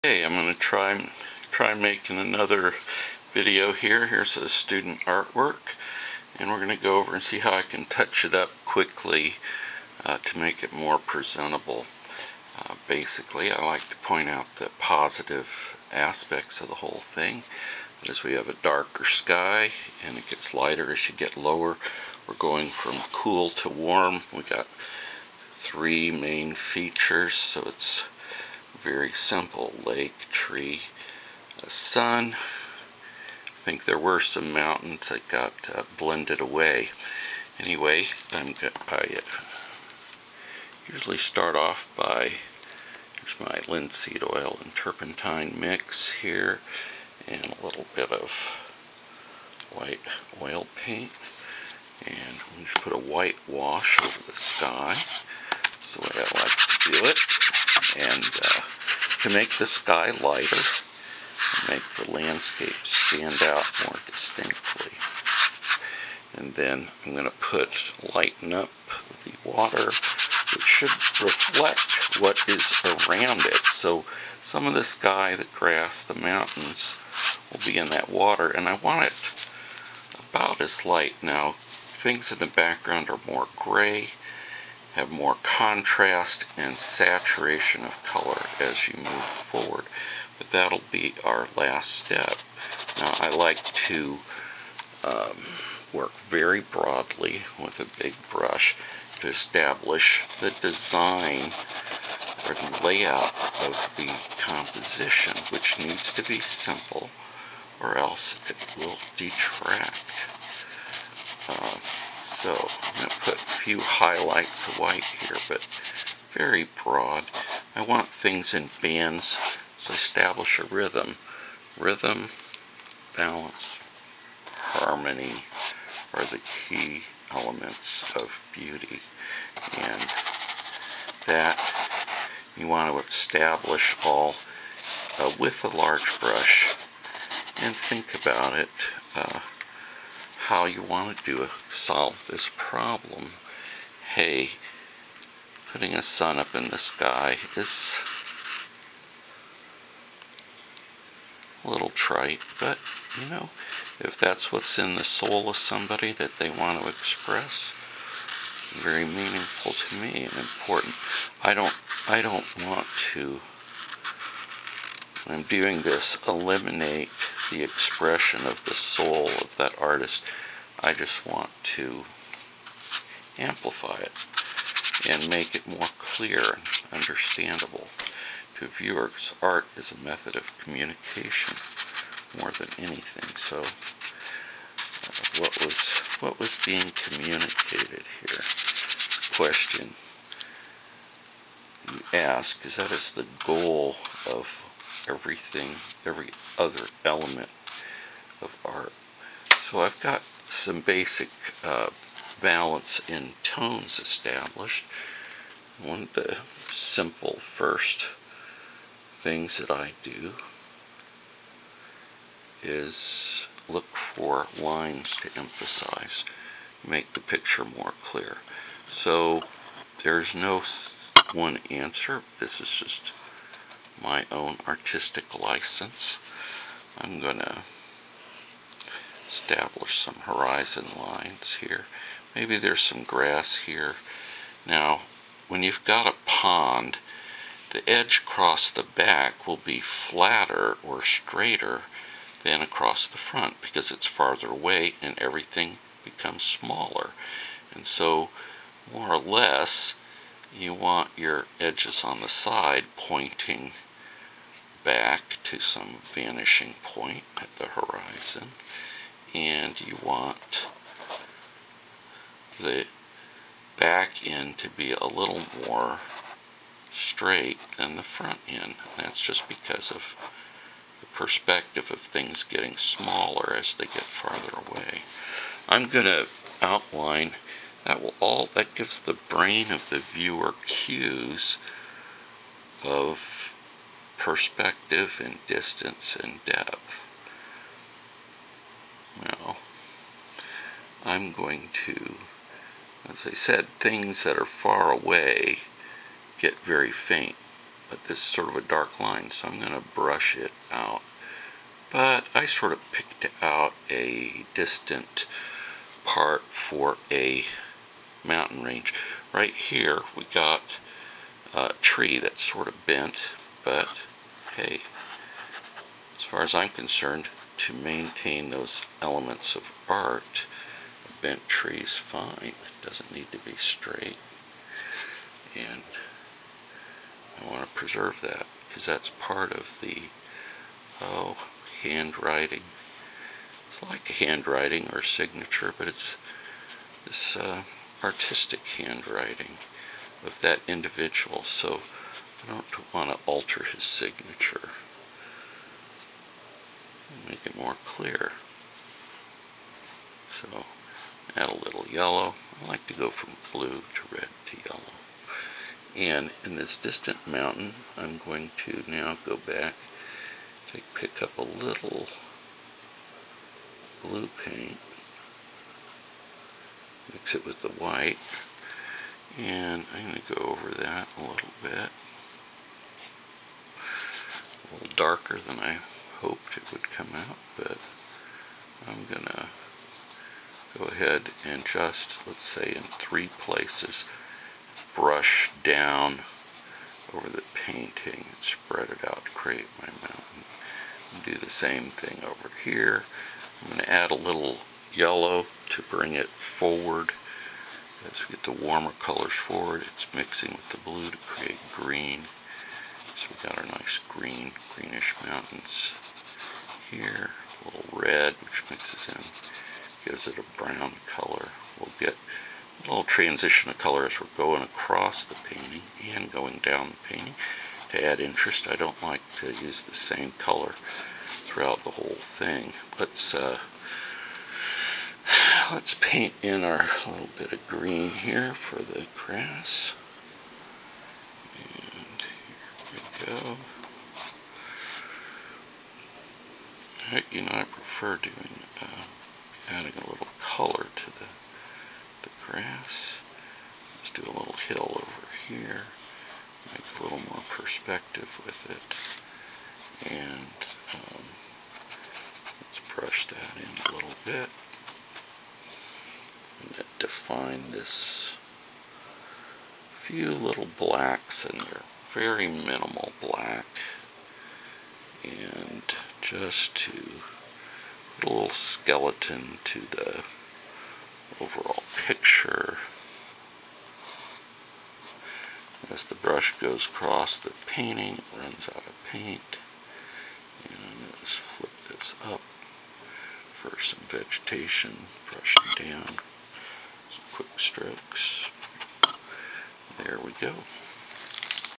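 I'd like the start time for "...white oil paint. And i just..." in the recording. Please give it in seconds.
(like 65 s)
49 s.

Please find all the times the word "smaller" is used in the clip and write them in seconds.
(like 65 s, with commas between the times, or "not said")
246 s, 272 s.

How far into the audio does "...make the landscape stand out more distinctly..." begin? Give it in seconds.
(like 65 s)
61 s.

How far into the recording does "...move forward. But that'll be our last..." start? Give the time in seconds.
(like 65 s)
88 s.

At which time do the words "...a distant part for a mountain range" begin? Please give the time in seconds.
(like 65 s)
303 s.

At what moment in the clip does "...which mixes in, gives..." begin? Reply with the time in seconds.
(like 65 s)
408 s.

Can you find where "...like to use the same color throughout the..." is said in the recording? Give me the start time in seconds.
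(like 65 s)
419 s.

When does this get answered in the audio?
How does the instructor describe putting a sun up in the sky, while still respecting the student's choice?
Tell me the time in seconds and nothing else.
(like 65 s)
151 s.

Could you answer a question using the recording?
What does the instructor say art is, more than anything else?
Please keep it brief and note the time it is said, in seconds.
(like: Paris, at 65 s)
A method of communication, at 179 s.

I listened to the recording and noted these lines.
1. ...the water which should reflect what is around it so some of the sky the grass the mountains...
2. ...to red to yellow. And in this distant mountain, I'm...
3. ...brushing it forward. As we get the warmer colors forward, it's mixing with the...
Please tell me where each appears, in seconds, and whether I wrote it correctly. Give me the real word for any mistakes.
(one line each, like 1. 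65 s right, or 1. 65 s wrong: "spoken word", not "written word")
1. 69 s right
2. 353 s right
3. 395 s wrong: "bring", not "brushing".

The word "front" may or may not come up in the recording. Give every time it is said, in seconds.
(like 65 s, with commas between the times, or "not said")
243 s, 268 s.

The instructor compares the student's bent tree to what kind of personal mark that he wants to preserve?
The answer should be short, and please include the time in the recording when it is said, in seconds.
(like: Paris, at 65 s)
Artistic handwriting, at 338 s.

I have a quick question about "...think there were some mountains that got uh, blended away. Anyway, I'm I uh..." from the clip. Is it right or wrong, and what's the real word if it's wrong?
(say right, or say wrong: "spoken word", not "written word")
right.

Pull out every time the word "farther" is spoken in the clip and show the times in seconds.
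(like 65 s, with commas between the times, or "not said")
244 s, 274 s.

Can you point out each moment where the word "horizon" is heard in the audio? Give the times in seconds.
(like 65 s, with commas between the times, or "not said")
230 s, 257 s.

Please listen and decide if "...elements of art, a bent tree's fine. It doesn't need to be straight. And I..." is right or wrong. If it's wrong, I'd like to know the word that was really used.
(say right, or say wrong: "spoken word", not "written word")
right.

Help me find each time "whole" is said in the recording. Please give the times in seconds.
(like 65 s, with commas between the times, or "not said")
16 s, 421 s.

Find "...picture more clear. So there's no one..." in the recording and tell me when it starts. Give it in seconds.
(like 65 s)
217 s.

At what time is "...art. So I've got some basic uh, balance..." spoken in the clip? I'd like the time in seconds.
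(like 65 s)
198 s.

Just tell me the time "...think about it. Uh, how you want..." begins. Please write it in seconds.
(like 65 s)
137 s.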